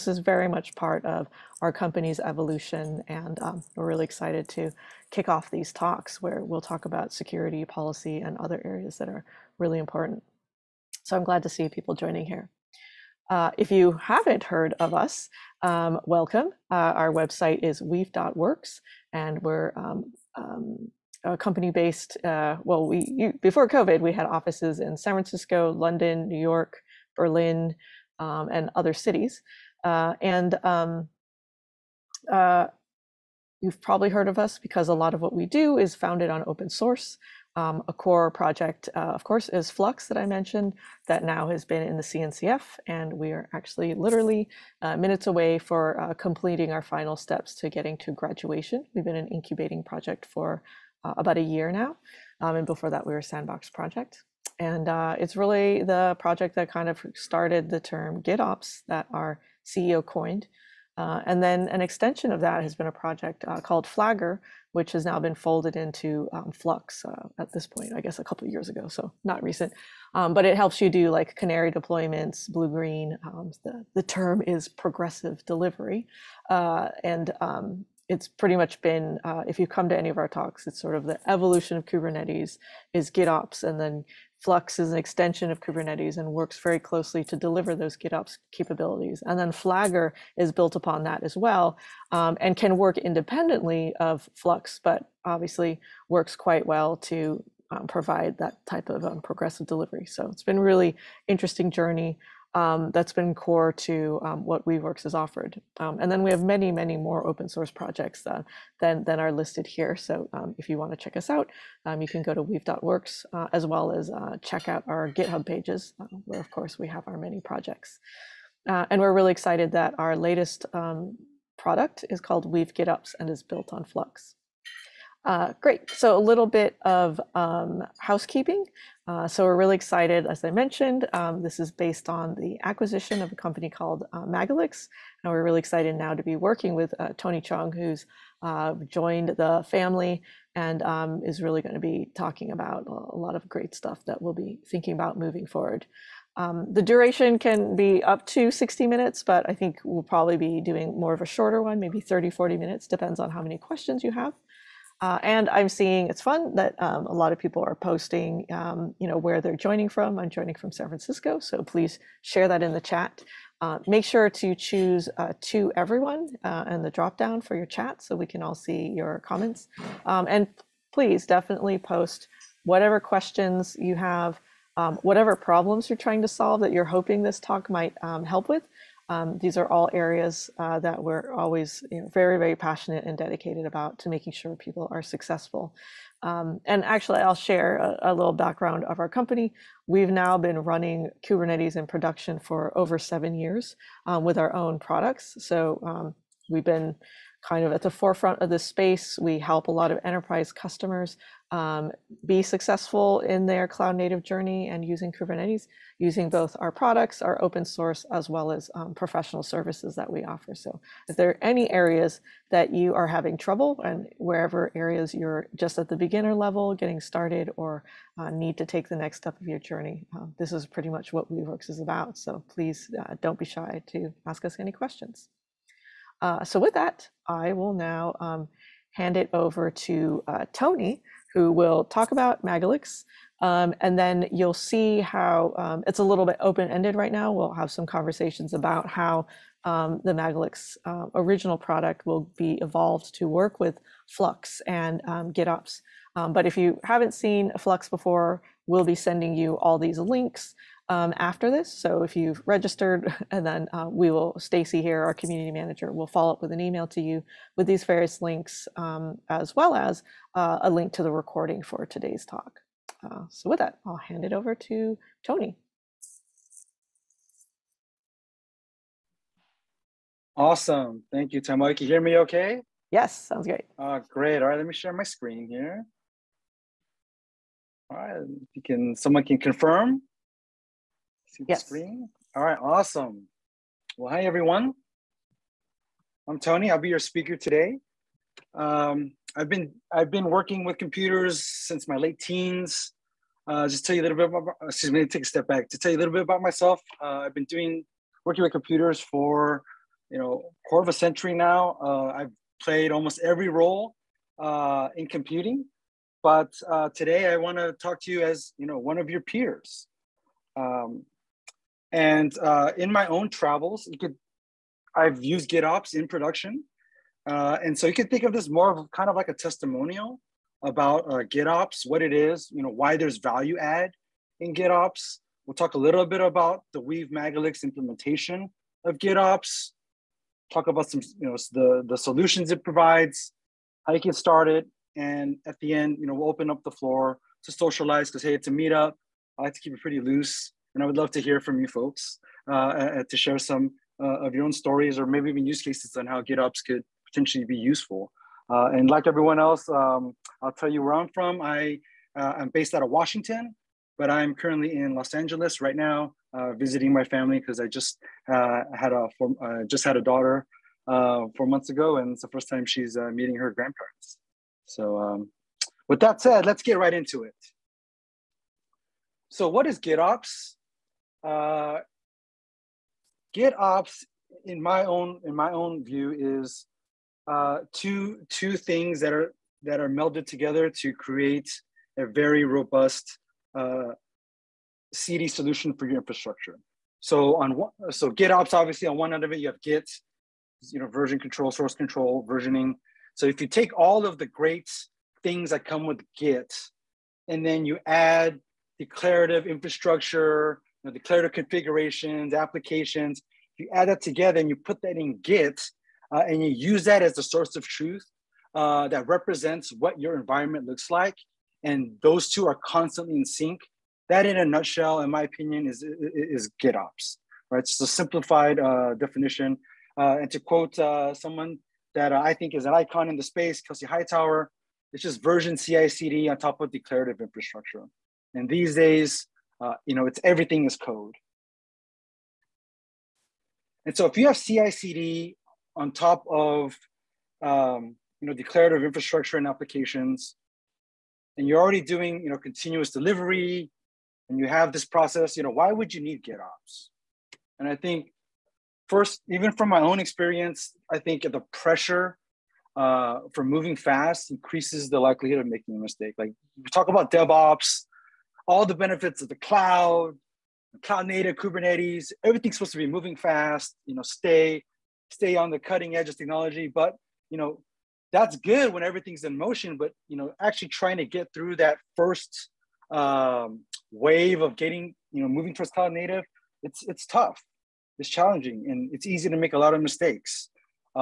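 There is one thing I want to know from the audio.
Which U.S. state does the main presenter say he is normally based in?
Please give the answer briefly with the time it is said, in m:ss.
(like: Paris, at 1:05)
Washington, at 5:52.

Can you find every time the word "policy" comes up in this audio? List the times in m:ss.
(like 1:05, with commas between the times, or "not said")
0:07.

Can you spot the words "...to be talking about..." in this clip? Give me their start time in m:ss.
2:21.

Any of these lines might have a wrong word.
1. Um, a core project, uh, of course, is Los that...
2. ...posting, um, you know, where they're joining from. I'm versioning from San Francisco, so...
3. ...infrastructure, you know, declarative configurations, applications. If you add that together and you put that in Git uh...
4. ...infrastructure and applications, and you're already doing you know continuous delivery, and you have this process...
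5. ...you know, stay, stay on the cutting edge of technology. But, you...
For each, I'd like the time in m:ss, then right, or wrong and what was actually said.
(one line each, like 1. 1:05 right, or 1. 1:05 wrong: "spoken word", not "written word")
1. 0:37 wrong: "Flux", not "Los"
2. 2:37 wrong: "joining", not "versioning"
3. 6:39 right
4. 7:18 right
5. 7:43 right.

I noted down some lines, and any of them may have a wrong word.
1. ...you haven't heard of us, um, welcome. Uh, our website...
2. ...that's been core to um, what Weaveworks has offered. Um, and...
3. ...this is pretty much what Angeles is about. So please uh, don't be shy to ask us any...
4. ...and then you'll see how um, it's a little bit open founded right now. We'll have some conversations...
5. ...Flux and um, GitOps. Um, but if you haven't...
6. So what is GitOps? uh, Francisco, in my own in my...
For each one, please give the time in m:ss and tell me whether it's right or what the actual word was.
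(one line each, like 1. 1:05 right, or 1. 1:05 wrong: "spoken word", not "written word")
1. 0:13 right
2. 1:42 right
3. 3:40 wrong: "Weaveworks", not "Angeles"
4. 3:53 wrong: "ended", not "founded"
5. 4:04 right
6. 6:09 wrong: "GitOps", not "Francisco".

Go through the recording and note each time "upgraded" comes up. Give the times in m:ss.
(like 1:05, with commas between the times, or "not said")
not said.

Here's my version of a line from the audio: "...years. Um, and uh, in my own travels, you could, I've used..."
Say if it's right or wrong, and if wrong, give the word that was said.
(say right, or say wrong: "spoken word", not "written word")
wrong: "peers", not "years".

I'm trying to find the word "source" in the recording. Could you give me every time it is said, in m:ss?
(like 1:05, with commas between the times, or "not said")
0:36, 1:47, 3:27, 6:31, 6:47.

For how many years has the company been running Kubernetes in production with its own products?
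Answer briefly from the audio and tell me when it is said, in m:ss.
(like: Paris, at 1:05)
7, at 3:12.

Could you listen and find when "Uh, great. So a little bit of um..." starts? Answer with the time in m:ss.
2:05.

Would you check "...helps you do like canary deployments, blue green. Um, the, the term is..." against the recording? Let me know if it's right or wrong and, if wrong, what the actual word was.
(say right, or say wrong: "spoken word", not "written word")
right.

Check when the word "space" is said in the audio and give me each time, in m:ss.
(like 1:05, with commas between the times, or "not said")
3:18, 7:03.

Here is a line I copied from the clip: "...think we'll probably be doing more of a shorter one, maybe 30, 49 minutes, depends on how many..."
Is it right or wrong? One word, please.
wrong.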